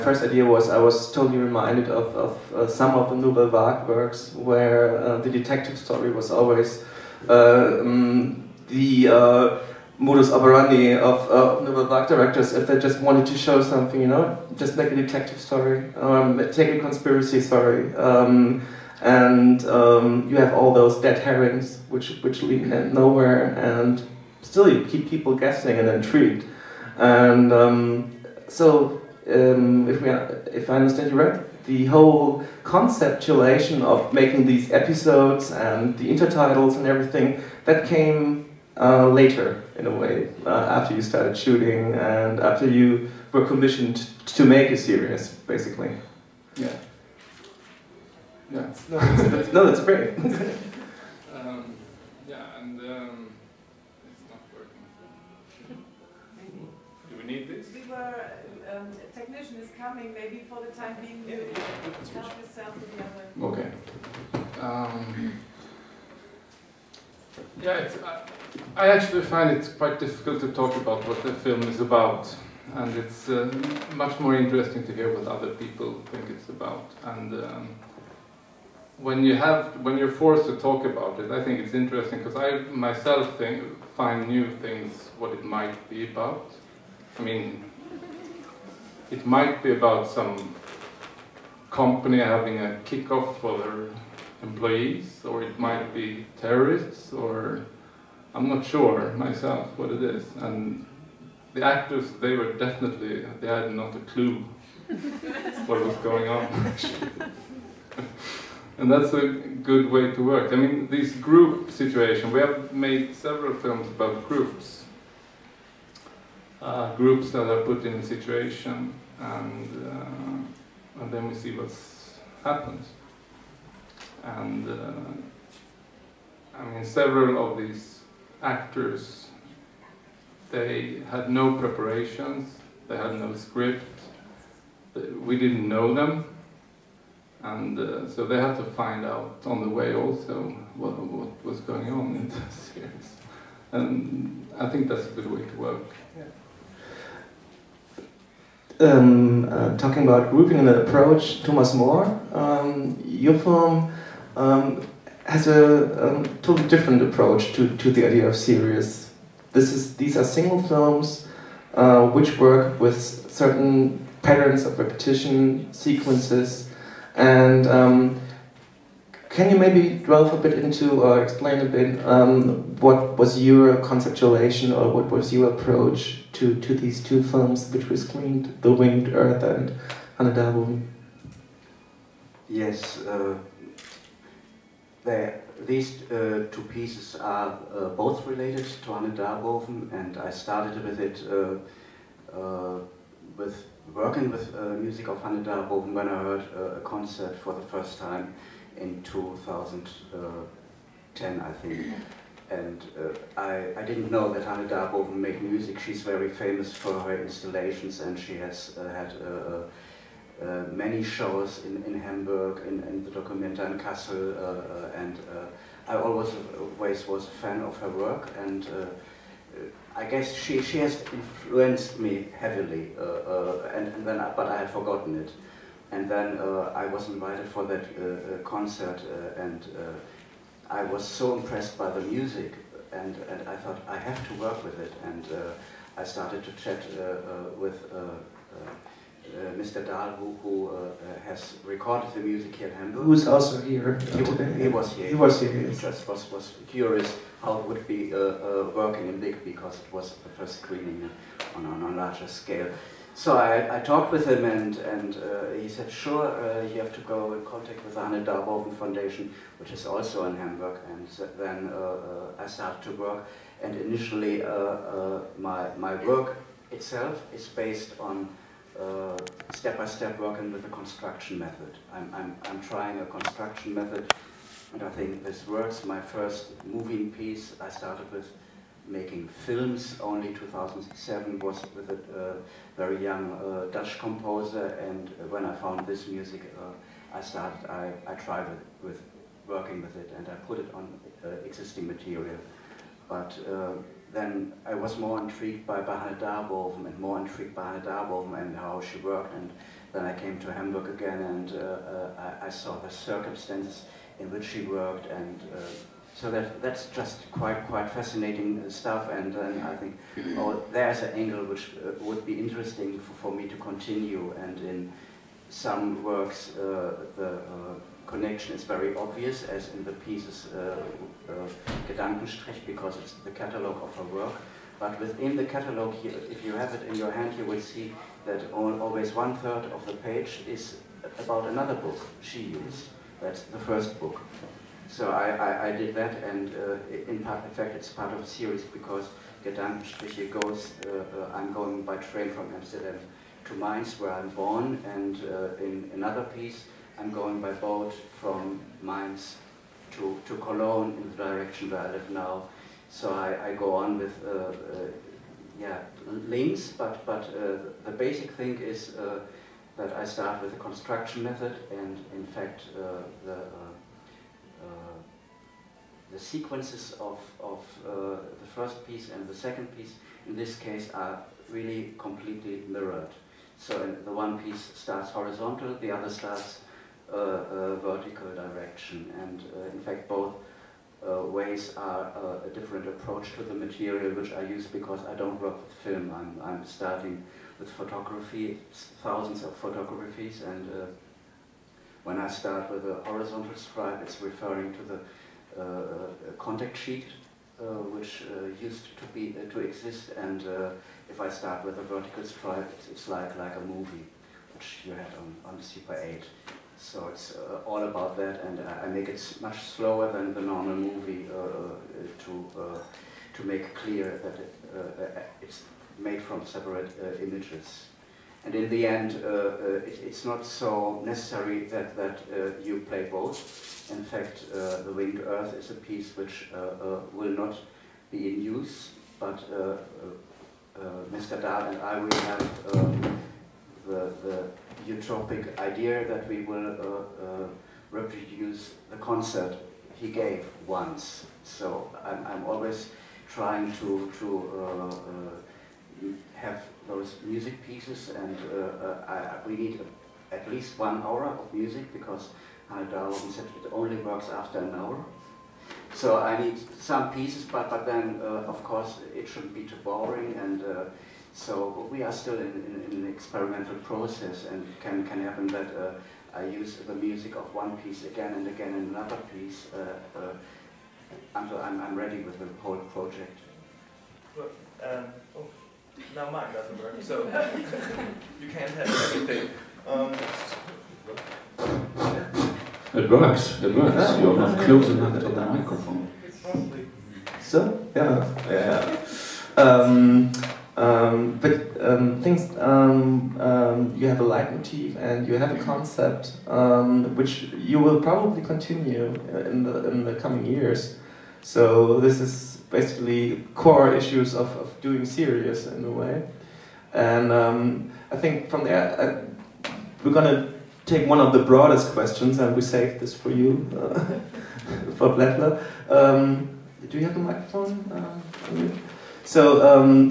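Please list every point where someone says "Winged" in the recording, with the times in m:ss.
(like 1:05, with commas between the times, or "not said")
2:58, 7:04.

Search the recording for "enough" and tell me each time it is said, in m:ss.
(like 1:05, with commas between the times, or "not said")
8:04.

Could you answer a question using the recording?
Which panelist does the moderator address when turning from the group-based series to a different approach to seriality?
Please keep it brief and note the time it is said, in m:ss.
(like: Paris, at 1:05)
Thomas Mohr, at 2:31.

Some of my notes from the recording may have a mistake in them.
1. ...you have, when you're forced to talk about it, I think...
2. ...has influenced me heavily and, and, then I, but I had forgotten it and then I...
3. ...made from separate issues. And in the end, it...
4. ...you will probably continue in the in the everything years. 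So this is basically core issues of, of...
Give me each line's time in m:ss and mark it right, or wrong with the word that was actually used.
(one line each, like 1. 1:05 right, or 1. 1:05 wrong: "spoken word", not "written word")
1. 1:19 right
2. 3:40 right
3. 6:55 wrong: "images", not "issues"
4. 8:17 wrong: "coming", not "everything".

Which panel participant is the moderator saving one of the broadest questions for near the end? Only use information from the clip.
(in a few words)
Blättler.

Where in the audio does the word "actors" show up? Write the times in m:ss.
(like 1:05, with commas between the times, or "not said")
1:41, 2:08.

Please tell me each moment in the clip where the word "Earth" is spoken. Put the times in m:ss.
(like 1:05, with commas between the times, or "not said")
2:59, 7:05.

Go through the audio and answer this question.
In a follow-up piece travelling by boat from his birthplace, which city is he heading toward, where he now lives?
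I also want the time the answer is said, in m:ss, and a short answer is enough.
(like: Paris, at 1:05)
Cologne, at 5:50.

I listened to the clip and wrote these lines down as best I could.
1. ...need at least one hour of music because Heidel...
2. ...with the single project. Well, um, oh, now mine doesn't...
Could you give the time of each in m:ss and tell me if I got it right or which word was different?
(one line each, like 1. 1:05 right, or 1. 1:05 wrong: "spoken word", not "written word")
1. 7:29 right
2. 7:52 wrong: "whole", not "single".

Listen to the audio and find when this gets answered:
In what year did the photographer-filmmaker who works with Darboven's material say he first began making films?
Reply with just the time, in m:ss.
4:40.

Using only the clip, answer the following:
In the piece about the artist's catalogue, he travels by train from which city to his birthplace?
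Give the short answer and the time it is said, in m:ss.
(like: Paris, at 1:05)
Amsterdam, at 5:42.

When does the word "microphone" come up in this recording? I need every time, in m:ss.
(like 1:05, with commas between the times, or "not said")
8:05, 8:37.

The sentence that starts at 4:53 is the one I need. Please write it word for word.
But uh, then I was more intrigued by Hanne Darboven and more intrigued by Hanne Darboven and how she worked.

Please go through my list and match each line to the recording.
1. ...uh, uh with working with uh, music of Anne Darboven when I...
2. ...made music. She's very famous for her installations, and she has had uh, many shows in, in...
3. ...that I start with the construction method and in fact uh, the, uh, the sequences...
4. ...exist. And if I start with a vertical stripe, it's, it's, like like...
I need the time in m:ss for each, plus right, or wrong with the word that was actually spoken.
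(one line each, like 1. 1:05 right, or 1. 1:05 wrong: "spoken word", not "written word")
1. 3:11 right
2. 3:25 right
3. 5:59 right
4. 6:39 right.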